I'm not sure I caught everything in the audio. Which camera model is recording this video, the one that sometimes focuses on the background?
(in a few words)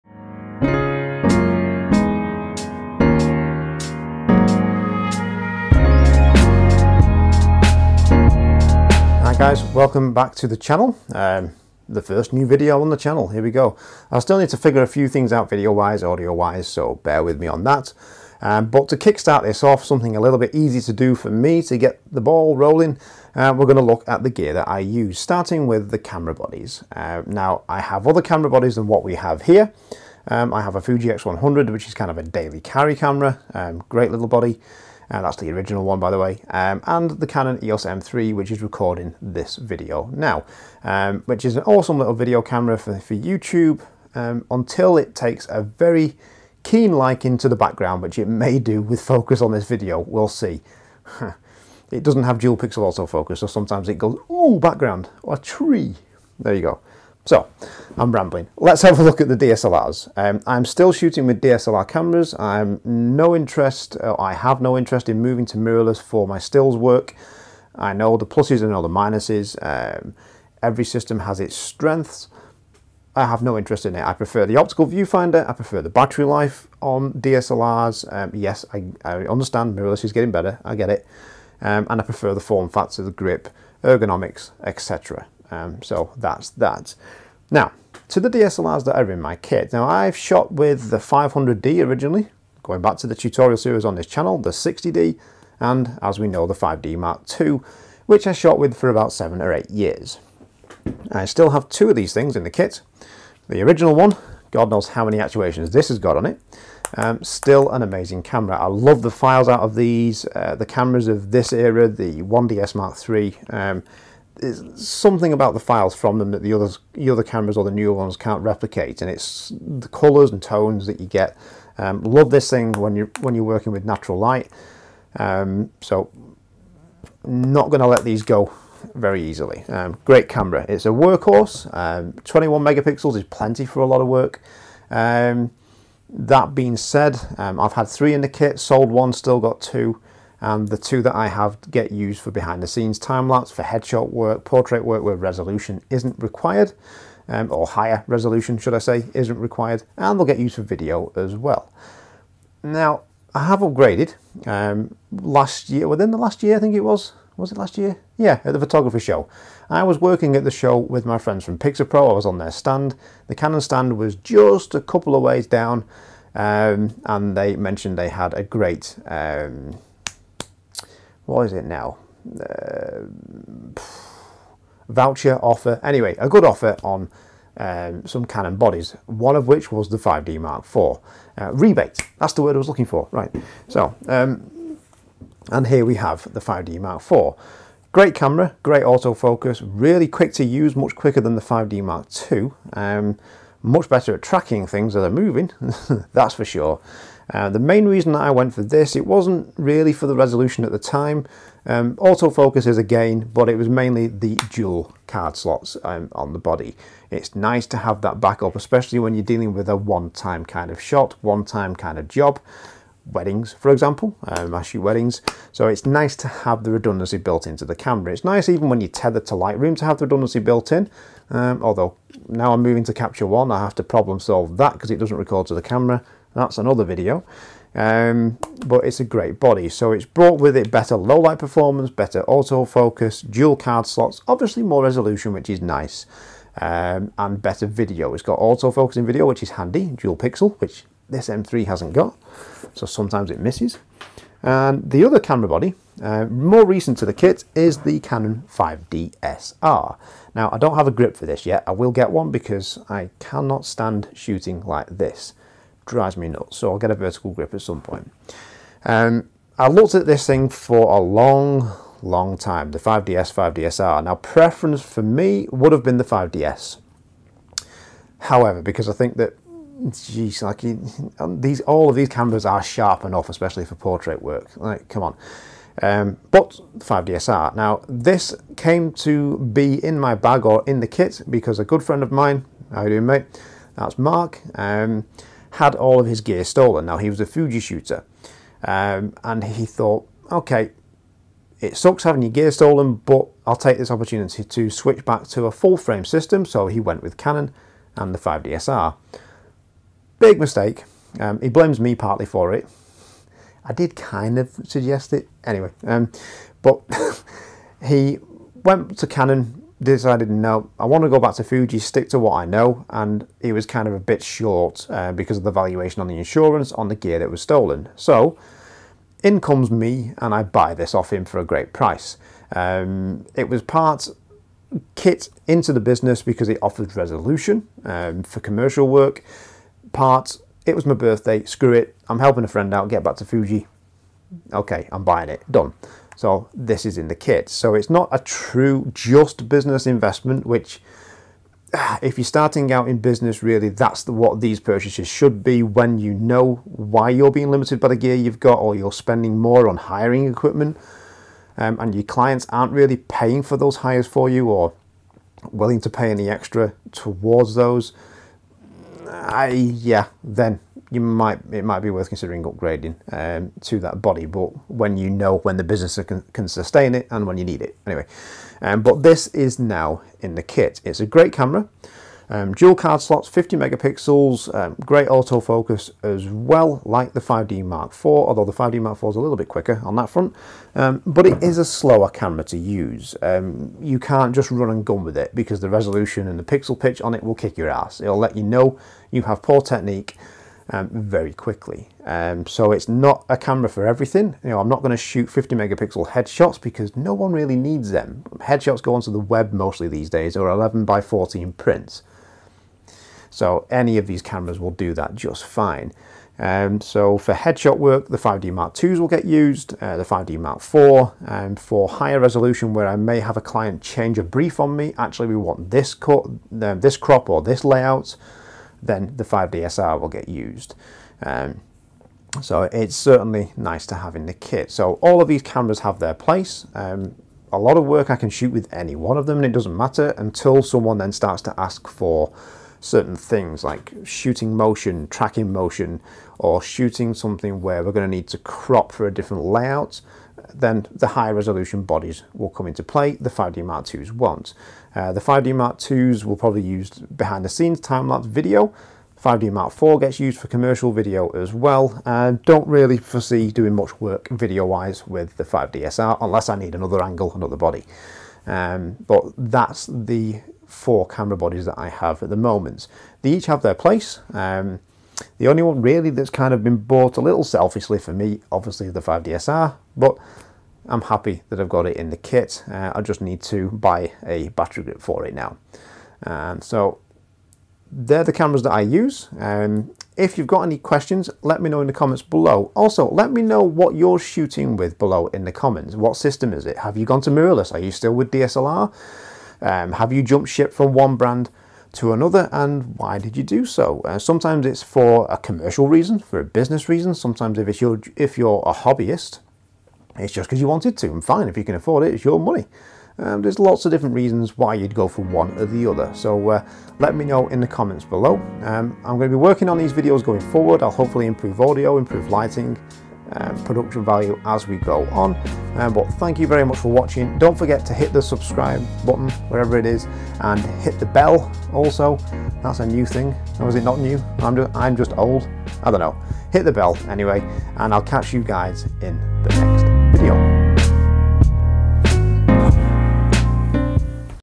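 Canon EOS M3.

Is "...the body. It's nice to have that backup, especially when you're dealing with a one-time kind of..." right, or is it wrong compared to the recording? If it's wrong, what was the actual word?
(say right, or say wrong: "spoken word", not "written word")
right.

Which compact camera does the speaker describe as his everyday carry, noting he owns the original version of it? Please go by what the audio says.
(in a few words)
Fuji X100.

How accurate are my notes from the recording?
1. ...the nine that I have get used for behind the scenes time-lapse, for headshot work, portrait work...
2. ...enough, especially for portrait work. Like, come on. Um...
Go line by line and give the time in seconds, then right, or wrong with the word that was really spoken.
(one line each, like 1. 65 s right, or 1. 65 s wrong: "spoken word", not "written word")
1. 140 s wrong: "two", not "nine"
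2. 273 s right.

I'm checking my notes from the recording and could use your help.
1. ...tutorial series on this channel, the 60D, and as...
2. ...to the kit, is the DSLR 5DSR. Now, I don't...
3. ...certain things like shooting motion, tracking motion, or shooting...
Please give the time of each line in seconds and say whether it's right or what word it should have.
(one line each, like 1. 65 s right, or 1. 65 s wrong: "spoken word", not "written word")
1. 93 s right
2. 246 s wrong: "Canon", not "DSLR"
3. 432 s right.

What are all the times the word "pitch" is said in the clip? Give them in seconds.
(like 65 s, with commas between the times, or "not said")
386 s.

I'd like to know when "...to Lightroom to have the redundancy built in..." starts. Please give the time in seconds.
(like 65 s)
219 s.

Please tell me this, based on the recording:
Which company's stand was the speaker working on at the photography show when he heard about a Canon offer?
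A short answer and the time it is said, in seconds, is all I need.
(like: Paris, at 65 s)
Pixapro, at 161 s.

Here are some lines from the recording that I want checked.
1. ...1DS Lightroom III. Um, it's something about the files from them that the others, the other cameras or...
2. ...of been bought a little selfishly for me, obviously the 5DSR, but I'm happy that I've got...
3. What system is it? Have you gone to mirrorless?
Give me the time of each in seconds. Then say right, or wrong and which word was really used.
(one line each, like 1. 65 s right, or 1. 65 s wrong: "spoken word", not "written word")
1. 112 s wrong: "Mark", not "Lightroom"
2. 466 s right
3. 485 s right.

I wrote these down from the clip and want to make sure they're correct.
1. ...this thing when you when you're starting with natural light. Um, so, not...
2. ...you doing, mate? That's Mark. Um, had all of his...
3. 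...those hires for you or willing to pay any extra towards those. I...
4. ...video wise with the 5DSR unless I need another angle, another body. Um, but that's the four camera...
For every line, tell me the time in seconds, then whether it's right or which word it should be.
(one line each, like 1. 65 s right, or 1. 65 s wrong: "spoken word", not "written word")
1. 122 s wrong: "working", not "starting"
2. 282 s right
3. 353 s right
4. 454 s right.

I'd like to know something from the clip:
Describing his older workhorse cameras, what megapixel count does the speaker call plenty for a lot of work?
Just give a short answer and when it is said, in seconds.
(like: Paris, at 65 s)
21, at 132 s.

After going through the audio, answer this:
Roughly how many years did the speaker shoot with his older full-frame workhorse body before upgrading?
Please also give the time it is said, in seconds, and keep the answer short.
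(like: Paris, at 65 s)
7 or 8, at 99 s.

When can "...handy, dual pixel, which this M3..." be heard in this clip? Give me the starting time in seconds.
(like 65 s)
239 s.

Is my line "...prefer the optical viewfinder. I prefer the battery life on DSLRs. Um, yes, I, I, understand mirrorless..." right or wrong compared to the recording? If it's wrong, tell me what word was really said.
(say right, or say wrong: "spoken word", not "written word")
right.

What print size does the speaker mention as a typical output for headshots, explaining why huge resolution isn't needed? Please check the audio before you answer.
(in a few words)
11 by 14.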